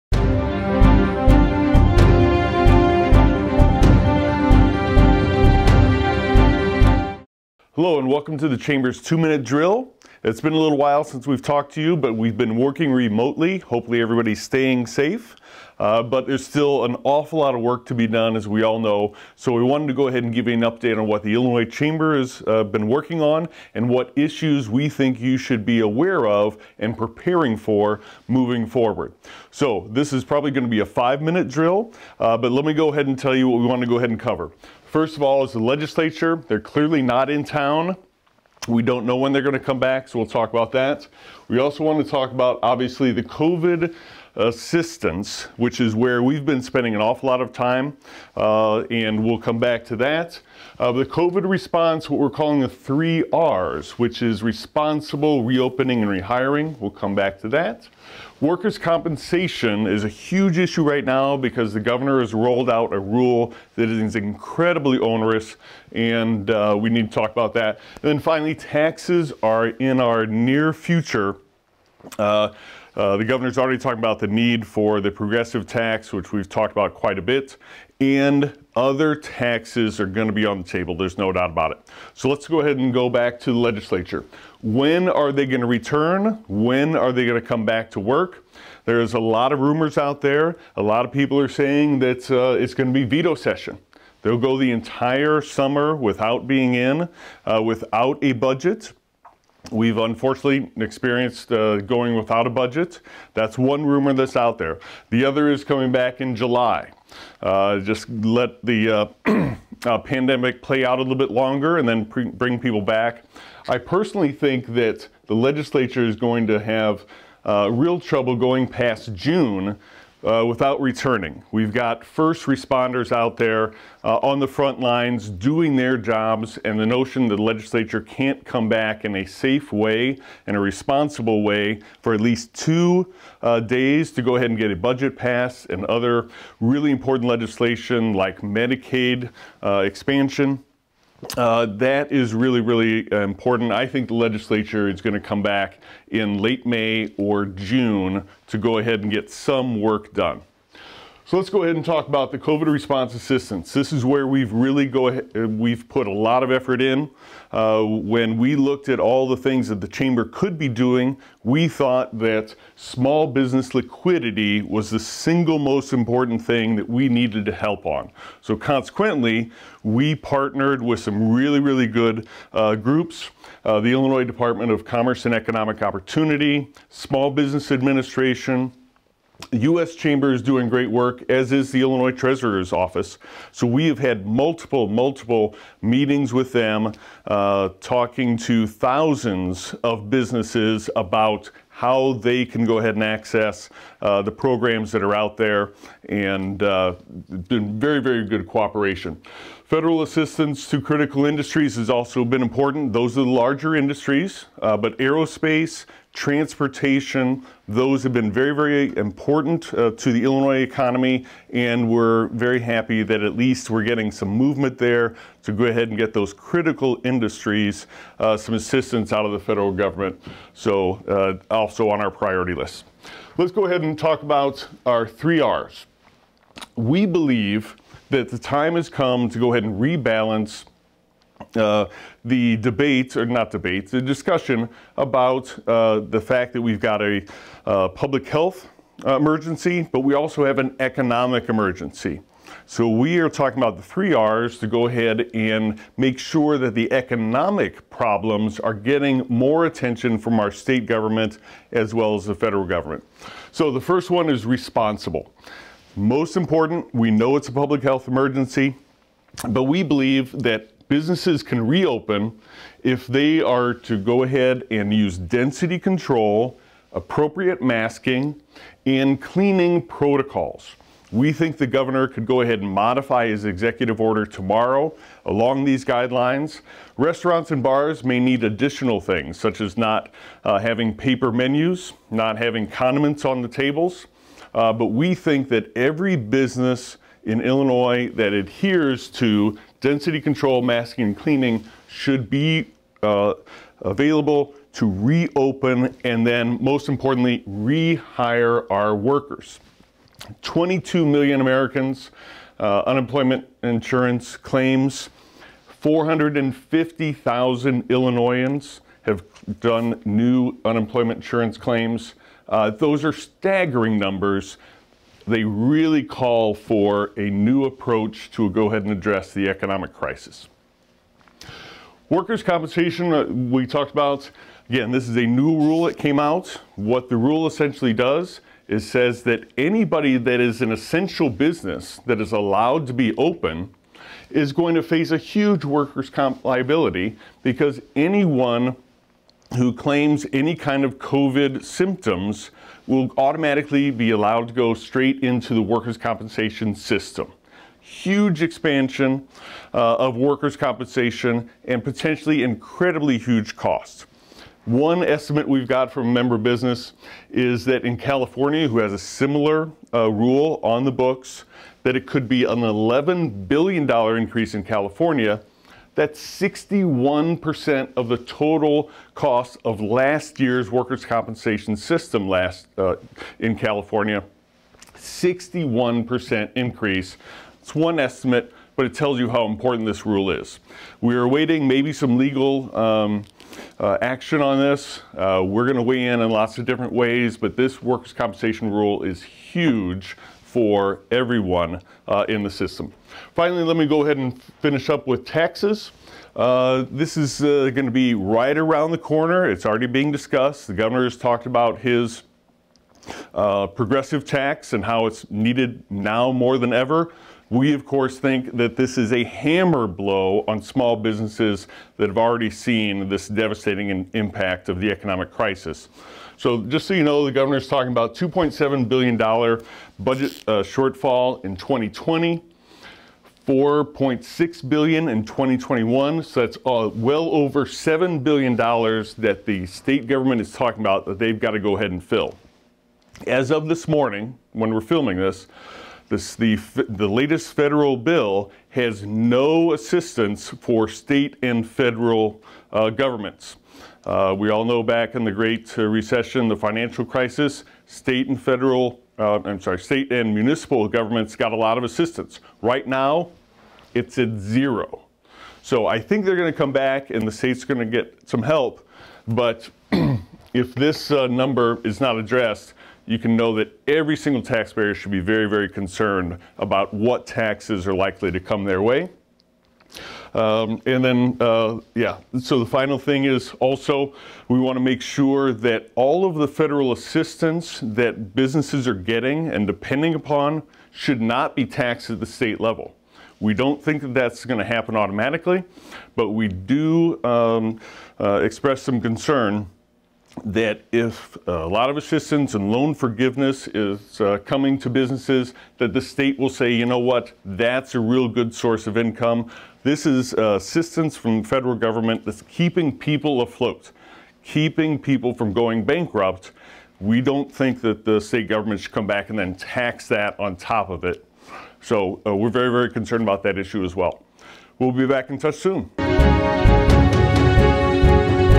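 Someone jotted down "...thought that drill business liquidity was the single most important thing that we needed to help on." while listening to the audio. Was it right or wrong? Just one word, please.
wrong.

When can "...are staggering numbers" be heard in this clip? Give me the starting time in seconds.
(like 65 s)
313 s.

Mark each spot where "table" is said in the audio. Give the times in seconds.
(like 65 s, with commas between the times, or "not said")
80 s, 283 s.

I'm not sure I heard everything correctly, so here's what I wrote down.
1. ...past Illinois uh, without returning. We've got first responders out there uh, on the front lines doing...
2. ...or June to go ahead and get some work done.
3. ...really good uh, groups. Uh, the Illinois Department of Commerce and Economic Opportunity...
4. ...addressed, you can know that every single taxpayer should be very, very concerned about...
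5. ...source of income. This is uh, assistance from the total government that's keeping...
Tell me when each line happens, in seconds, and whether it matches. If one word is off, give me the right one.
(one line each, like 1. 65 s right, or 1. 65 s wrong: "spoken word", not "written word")
1. 118 s wrong: "June", not "Illinois"
2. 147 s right
3. 171 s right
4. 462 s right
5. 498 s wrong: "federal", not "total".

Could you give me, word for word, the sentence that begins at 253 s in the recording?
So the first one is responsible.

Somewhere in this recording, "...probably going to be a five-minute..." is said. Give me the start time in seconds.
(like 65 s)
30 s.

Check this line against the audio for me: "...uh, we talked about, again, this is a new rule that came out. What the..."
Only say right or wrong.
right.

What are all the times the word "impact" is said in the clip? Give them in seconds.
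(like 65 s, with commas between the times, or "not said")
414 s.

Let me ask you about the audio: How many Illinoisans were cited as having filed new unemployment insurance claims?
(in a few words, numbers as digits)
450,000.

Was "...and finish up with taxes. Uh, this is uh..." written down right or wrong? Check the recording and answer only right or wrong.
right.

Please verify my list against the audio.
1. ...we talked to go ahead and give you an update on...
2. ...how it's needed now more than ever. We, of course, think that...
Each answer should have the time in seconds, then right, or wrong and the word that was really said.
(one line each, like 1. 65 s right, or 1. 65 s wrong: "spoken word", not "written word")
1. 19 s wrong: "wanted", not "talked"
2. 404 s right.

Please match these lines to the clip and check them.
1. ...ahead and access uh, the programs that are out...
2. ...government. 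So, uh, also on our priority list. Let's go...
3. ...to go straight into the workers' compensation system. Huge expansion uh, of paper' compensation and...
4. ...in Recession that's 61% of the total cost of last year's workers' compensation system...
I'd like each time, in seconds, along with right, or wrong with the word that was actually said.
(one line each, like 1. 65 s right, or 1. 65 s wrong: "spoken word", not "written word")
1. 192 s right
2. 219 s right
3. 344 s wrong: "workers", not "paper"
4. 364 s wrong: "California", not "Recession".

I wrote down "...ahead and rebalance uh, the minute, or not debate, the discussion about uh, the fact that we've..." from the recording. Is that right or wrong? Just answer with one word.
wrong.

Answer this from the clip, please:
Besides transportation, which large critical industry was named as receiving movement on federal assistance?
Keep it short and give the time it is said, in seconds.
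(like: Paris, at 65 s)
aerospace, at 204 s.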